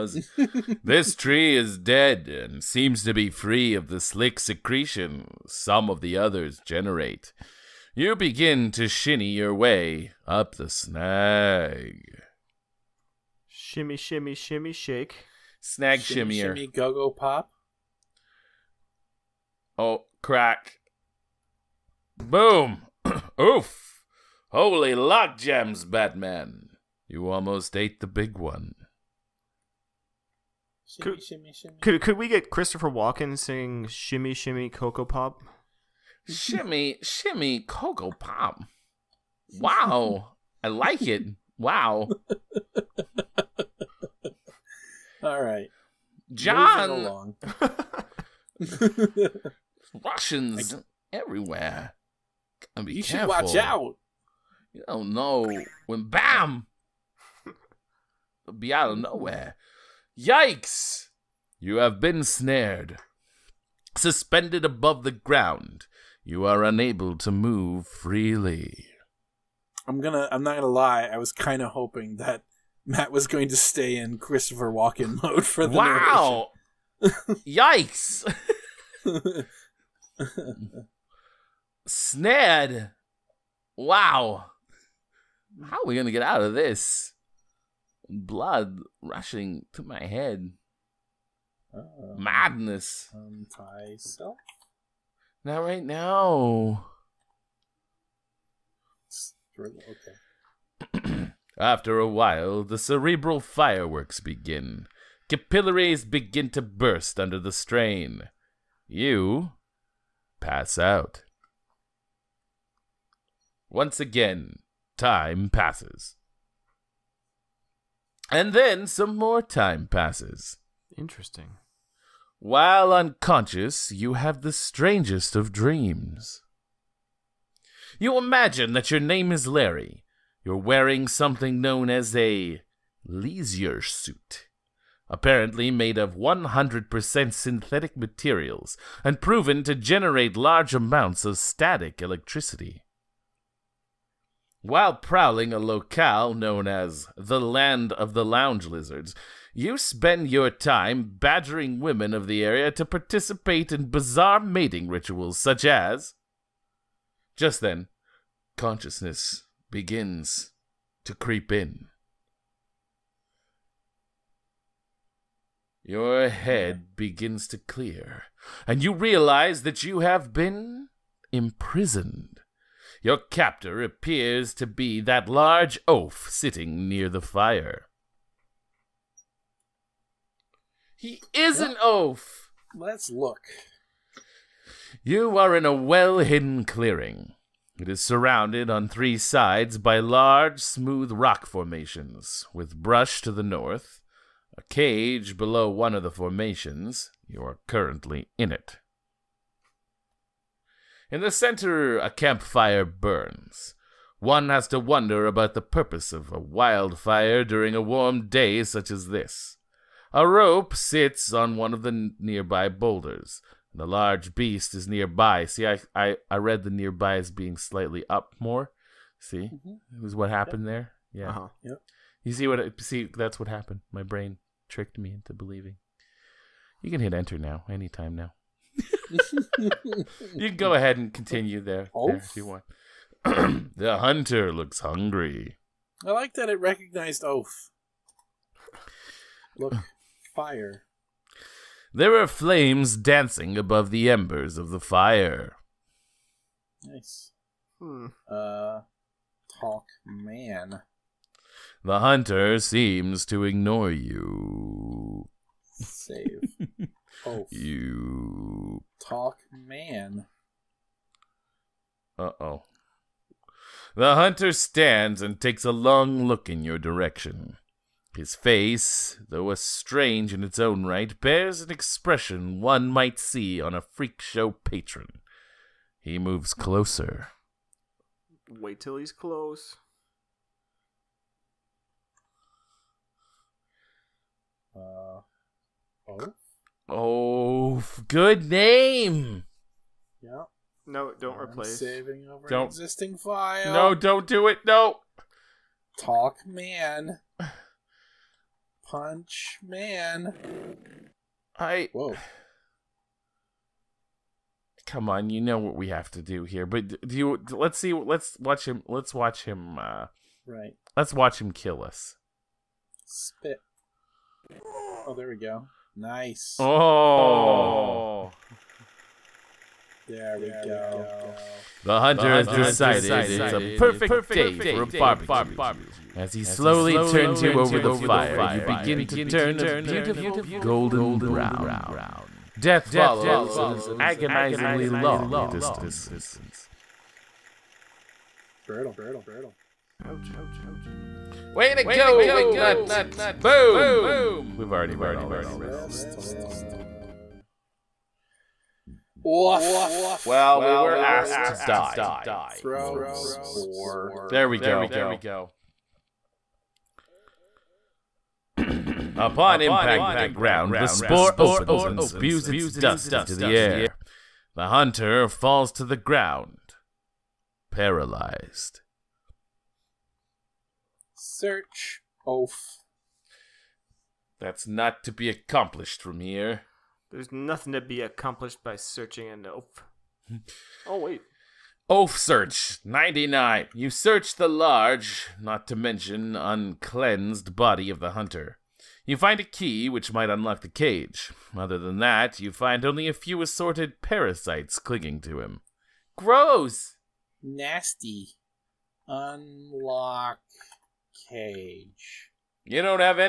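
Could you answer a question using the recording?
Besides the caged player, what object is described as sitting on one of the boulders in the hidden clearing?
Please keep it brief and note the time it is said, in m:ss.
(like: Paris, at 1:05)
A rope, at 3:30.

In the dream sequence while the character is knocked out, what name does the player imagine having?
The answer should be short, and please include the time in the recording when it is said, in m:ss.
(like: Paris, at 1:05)
Larry, at 2:09.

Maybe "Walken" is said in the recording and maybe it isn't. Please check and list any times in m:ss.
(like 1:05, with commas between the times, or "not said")
0:32, 1:14.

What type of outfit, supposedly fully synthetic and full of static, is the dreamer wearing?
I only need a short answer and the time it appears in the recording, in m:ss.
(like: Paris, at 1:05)
leisure suit, at 2:13.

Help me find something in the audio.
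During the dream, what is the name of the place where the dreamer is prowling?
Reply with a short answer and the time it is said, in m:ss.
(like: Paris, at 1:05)
Land of the Lounge Lizards, at 2:27.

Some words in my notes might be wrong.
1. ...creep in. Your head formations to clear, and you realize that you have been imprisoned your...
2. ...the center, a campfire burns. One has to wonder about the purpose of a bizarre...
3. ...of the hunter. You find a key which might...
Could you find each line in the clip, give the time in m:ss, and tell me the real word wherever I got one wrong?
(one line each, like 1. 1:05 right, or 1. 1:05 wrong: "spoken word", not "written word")
1. 2:41 wrong: "begins", not "formations"
2. 3:21 wrong: "wildfire", not "bizarre"
3. 6:27 right.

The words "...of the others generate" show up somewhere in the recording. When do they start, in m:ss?
0:05.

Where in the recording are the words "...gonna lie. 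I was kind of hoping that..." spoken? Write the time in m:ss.
1:10.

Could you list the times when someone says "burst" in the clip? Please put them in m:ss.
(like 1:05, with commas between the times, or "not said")
1:46.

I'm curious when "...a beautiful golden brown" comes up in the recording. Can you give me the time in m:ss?
5:29.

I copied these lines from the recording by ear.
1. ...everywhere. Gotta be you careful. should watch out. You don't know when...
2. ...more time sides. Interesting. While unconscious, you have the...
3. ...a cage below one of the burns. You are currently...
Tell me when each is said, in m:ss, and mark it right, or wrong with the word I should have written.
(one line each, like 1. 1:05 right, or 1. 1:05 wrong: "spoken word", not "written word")
1. 0:51 right
2. 1:59 wrong: "passes", not "sides"
3. 3:14 wrong: "formations", not "burns".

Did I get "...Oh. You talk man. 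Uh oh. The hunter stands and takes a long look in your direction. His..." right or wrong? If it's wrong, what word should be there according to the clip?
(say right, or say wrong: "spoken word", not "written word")
right.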